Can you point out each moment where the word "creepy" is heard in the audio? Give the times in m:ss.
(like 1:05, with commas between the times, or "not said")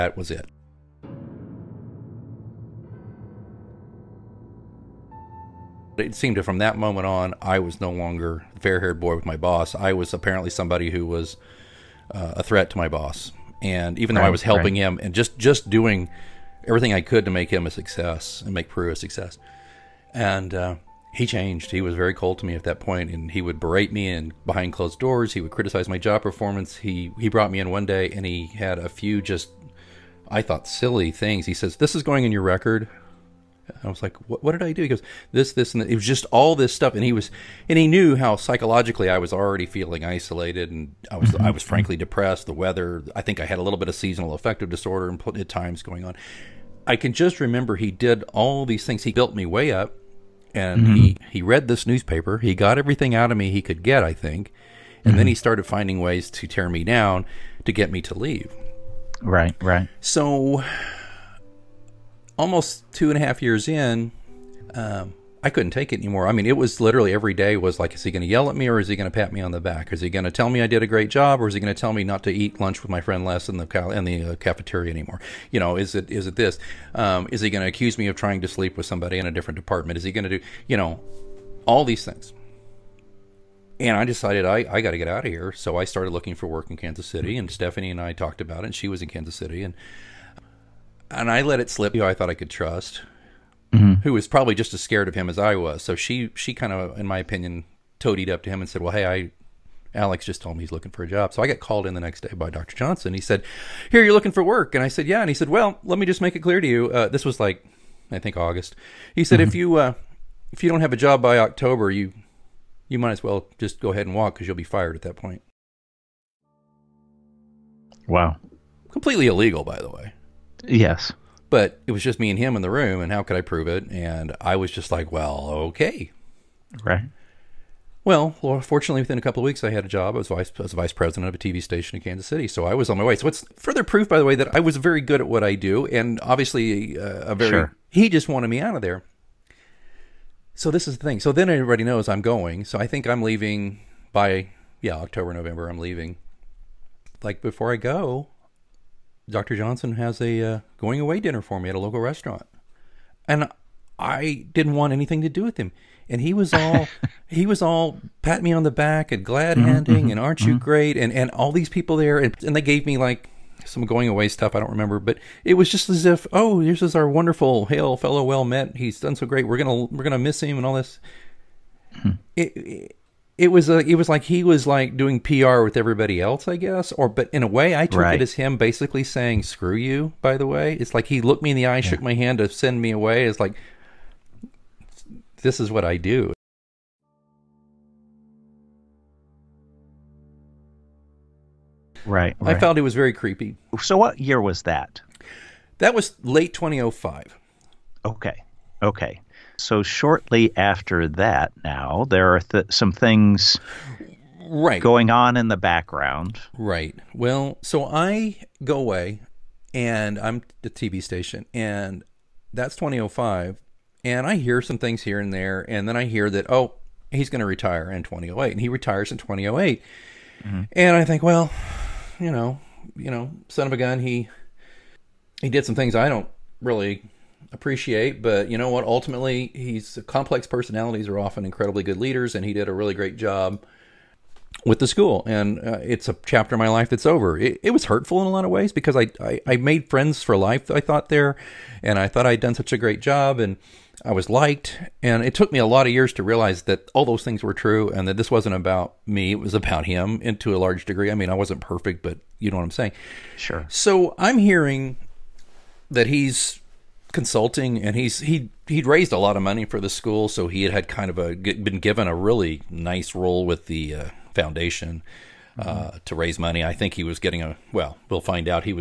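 3:13.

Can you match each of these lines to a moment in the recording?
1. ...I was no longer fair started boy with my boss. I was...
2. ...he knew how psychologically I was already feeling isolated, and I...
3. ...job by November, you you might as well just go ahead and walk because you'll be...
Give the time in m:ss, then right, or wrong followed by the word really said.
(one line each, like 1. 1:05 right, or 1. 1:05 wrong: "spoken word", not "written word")
1. 0:07 wrong: "haired", not "started"
2. 0:37 right
3. 1:50 wrong: "October", not "November".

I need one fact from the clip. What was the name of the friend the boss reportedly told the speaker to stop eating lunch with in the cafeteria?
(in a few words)
Les.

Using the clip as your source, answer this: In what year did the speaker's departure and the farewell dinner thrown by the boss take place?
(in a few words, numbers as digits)
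2005.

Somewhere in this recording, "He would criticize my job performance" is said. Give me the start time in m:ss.
0:25.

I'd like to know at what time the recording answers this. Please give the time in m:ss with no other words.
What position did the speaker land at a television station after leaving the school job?
2:10.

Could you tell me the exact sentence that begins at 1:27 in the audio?
And Stephanie and I talked about it.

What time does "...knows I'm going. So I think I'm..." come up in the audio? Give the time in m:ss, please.
2:21.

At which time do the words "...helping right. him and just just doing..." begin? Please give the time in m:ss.
0:14.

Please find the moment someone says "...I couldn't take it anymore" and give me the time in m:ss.
1:05.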